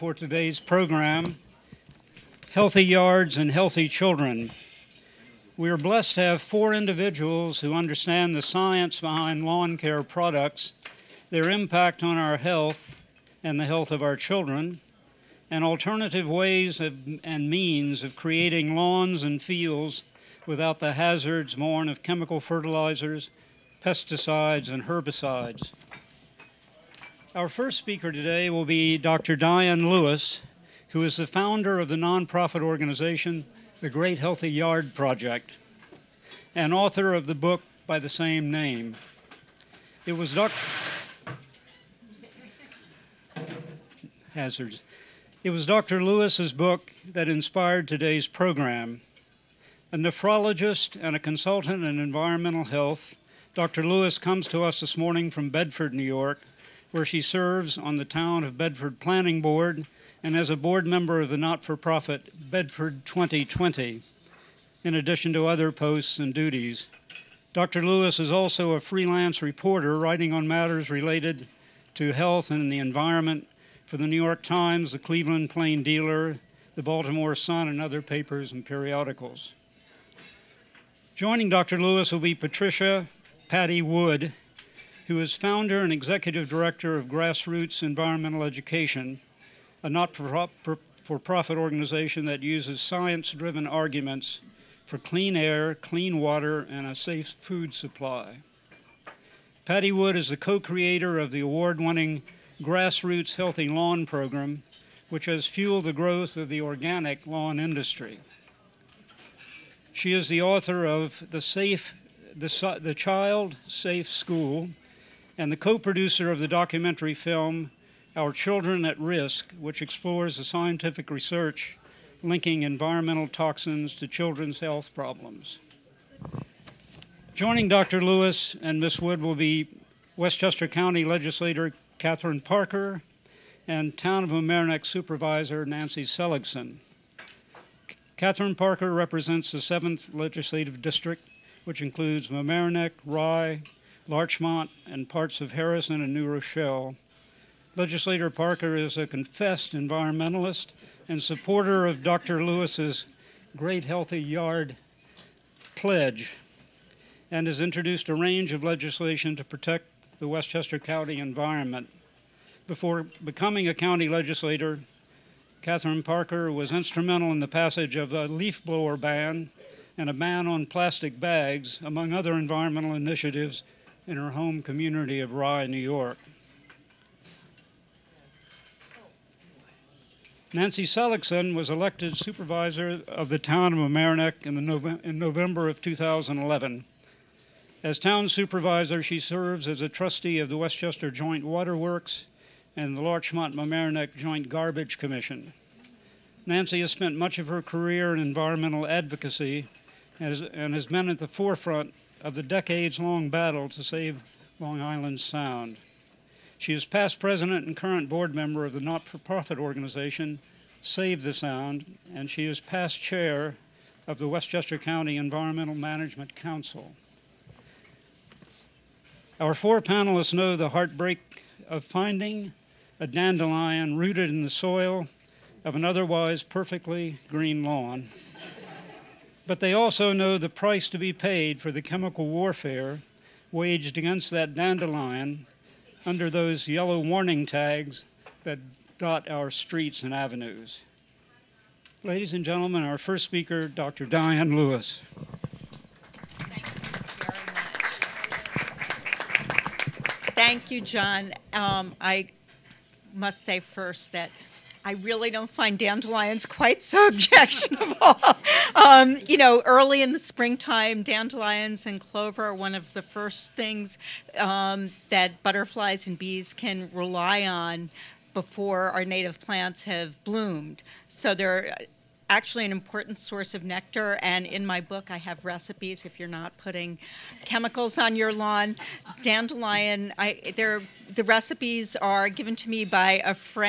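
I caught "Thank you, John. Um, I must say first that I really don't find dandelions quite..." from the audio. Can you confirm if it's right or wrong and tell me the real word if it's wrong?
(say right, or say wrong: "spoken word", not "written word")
right.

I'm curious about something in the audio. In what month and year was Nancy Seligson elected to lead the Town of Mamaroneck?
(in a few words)
November 2011.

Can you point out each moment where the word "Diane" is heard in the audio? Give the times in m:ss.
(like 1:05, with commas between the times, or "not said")
0:29, 4:04.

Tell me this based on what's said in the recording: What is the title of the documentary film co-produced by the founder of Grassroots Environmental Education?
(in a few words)
Our Children at Risk.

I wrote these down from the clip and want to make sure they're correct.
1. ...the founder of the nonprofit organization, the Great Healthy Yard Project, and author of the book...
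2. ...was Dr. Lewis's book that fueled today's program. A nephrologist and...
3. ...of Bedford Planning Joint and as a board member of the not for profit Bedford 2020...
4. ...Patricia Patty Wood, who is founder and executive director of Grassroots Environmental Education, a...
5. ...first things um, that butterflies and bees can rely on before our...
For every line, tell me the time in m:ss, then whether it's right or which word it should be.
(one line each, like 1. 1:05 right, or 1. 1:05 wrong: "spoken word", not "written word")
1. 0:31 right
2. 0:45 wrong: "inspired", not "fueled"
3. 0:58 wrong: "Board", not "Joint"
4. 1:22 right
5. 4:23 right.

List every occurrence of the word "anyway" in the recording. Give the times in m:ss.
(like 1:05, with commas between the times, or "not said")
not said.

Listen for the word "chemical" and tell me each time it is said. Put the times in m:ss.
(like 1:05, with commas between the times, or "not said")
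0:22, 3:51, 4:37.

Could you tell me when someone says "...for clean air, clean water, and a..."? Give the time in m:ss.
1:34.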